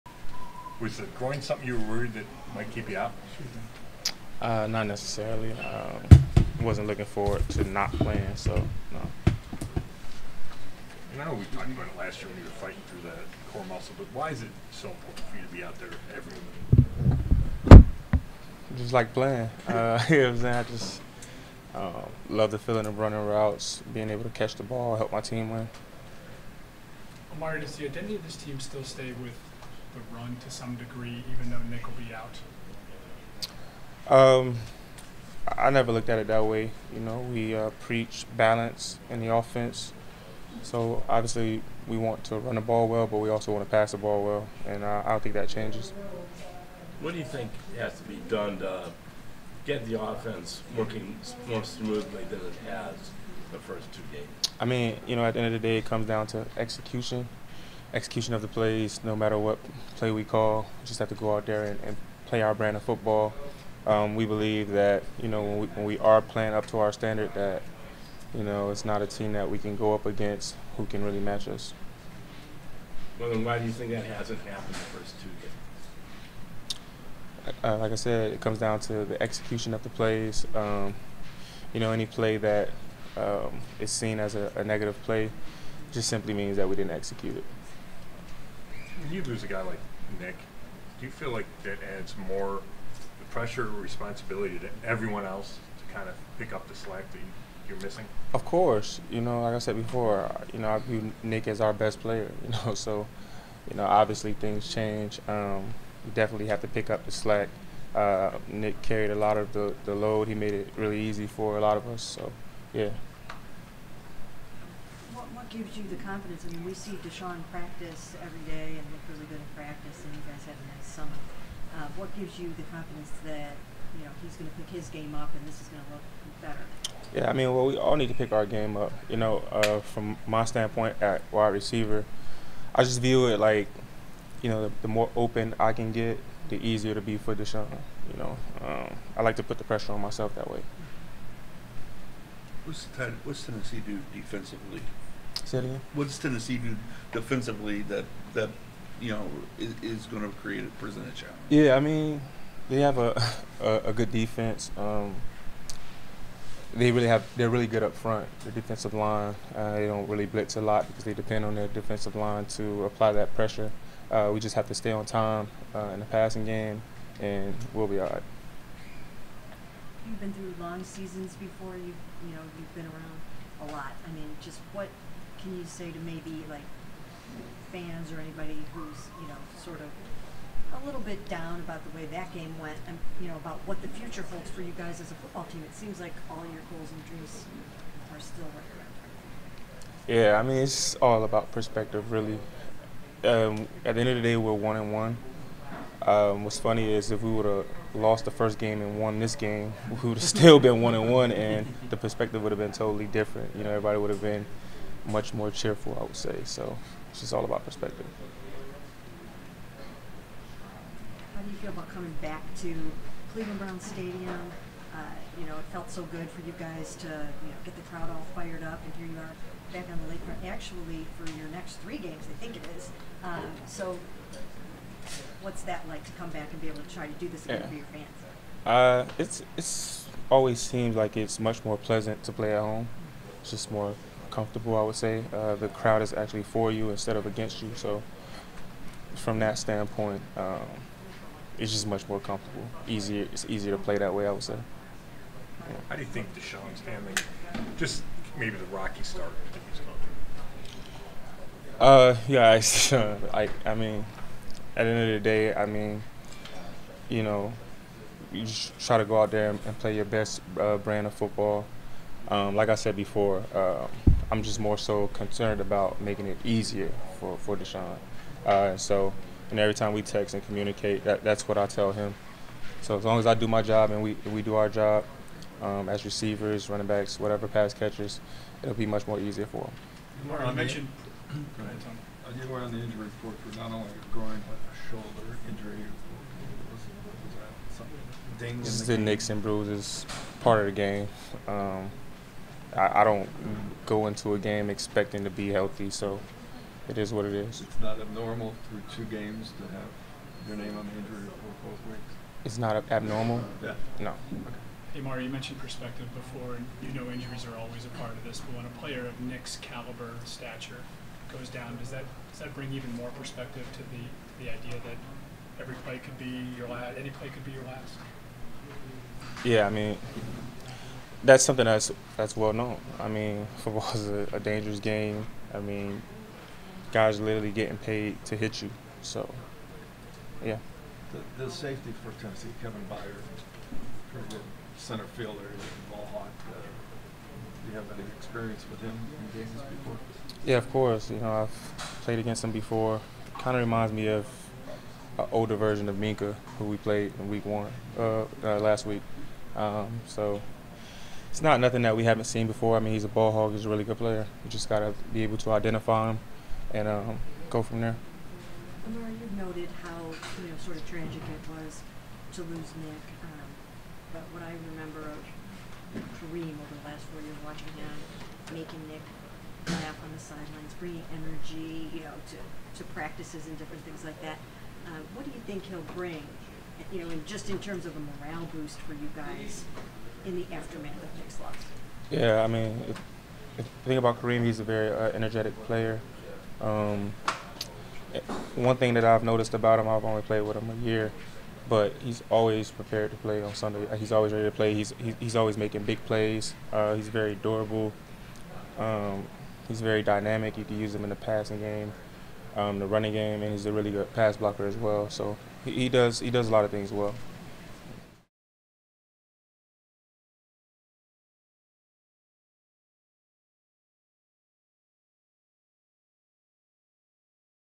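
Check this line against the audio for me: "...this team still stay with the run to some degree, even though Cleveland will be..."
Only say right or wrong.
wrong.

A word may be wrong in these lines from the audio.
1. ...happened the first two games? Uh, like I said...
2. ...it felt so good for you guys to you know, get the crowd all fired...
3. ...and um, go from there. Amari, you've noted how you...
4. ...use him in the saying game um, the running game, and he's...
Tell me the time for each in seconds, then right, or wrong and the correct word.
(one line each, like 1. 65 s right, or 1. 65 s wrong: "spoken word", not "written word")
1. 74 s right
2. 215 s right
3. 356 s right
4. 400 s wrong: "passing", not "saying".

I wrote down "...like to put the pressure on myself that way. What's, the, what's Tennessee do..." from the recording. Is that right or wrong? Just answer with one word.
right.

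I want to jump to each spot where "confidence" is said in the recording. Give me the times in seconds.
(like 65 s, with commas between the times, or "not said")
115 s, 122 s.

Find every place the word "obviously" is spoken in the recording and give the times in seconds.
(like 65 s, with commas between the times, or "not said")
41 s, 103 s.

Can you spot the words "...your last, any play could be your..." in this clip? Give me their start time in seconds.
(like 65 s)
316 s.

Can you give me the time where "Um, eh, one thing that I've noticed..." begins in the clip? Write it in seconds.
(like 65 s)
386 s.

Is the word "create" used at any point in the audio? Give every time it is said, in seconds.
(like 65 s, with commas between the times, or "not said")
150 s.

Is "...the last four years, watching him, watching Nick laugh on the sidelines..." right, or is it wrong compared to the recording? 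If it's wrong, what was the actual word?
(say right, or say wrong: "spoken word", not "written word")
wrong: "making", not "watching".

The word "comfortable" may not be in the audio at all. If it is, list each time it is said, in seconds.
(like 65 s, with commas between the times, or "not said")
234 s, 242 s.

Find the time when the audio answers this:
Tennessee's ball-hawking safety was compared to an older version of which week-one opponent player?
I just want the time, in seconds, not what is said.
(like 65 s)
345 s.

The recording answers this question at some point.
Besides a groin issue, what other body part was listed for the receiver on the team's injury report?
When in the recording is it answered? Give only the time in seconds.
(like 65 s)
284 s.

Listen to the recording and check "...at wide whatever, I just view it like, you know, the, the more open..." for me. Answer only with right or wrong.
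wrong.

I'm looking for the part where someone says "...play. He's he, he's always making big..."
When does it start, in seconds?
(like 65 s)
394 s.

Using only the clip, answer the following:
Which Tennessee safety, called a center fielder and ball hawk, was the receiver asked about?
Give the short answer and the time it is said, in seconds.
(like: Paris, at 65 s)
Kevin Byard, at 332 s.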